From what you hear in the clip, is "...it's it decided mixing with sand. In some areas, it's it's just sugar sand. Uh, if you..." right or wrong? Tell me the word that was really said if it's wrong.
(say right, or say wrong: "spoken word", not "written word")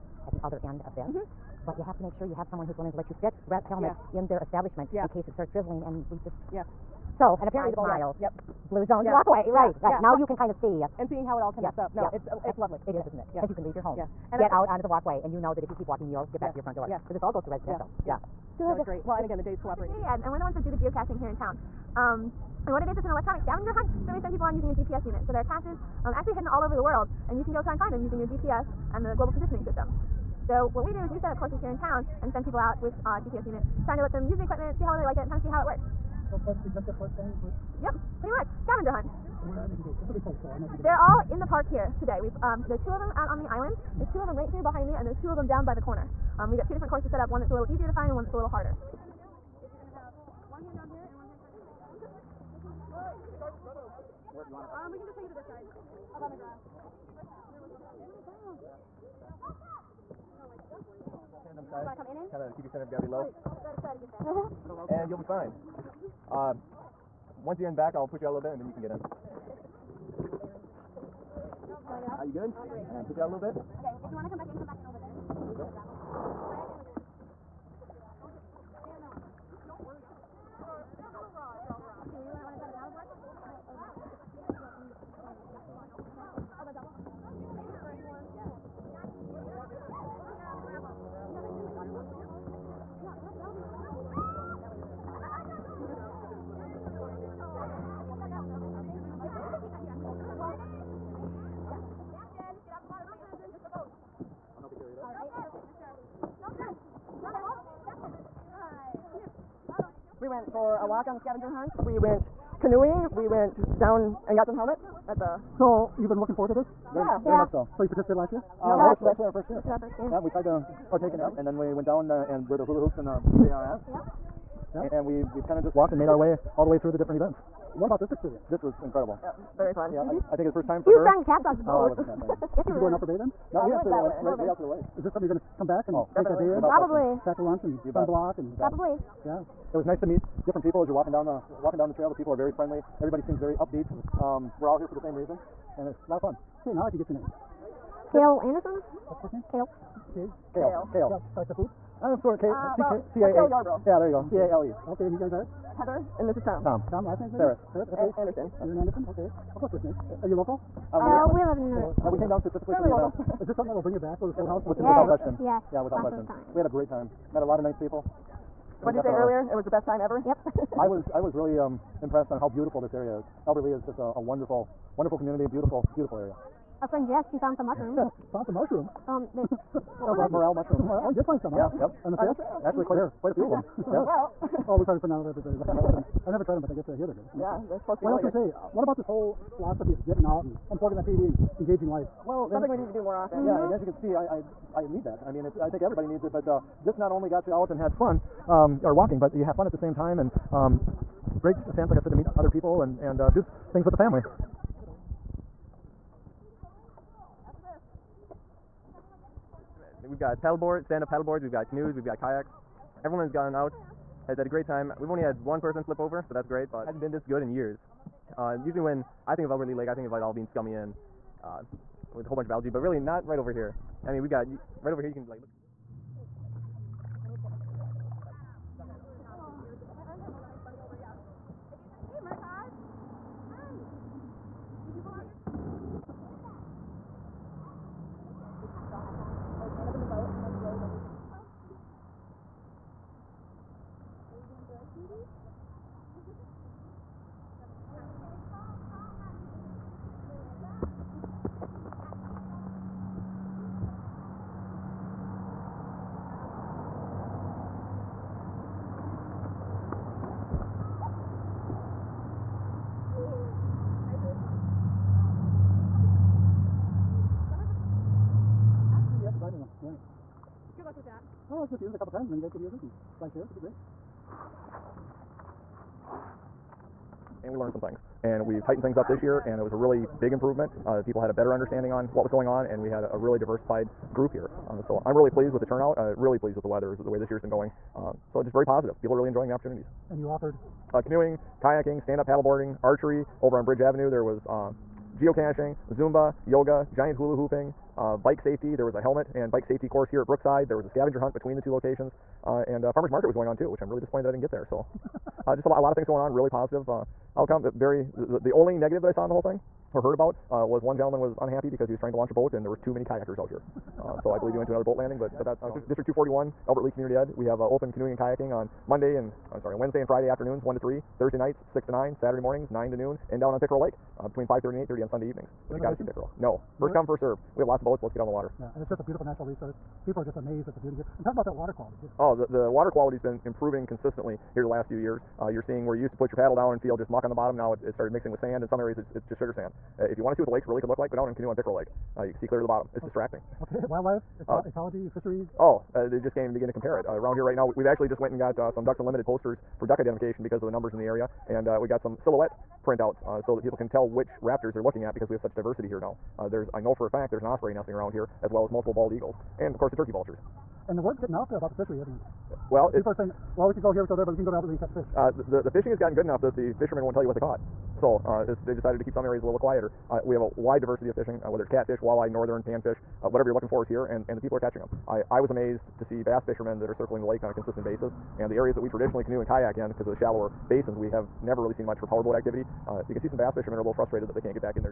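wrong: "started", not "decided".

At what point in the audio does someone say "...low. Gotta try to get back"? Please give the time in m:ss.
1:03.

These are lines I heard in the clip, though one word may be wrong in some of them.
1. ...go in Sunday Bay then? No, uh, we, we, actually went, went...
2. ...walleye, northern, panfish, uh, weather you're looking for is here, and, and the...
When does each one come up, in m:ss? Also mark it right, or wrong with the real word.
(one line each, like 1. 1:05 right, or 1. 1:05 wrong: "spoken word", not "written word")
1. 2:12 wrong: "Upper", not "Sunday"
2. 6:11 wrong: "whatever", not "weather".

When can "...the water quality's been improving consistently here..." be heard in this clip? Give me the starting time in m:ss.
5:32.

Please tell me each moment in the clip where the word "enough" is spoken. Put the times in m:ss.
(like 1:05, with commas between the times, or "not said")
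6:06.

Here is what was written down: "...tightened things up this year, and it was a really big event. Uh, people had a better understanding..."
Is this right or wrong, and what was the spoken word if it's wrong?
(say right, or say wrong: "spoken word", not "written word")
wrong: "improvement", not "event".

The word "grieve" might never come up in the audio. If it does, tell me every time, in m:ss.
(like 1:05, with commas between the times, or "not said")
not said.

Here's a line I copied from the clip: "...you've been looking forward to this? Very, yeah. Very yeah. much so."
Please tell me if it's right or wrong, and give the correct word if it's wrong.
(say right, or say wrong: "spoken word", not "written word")
right.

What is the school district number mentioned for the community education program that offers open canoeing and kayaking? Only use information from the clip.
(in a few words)
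241.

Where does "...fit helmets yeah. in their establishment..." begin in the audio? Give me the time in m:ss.
0:03.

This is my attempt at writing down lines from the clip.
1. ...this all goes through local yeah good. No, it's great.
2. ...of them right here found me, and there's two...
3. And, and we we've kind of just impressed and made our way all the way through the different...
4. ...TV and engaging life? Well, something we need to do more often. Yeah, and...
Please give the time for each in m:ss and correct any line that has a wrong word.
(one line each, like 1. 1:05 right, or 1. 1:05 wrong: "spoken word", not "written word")
1. 0:17 wrong: "residential", not "local"
2. 0:44 wrong: "behind", not "found"
3. 2:04 wrong: "walked", not "impressed"
4. 3:11 right.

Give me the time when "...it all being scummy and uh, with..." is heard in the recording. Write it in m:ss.
3:40.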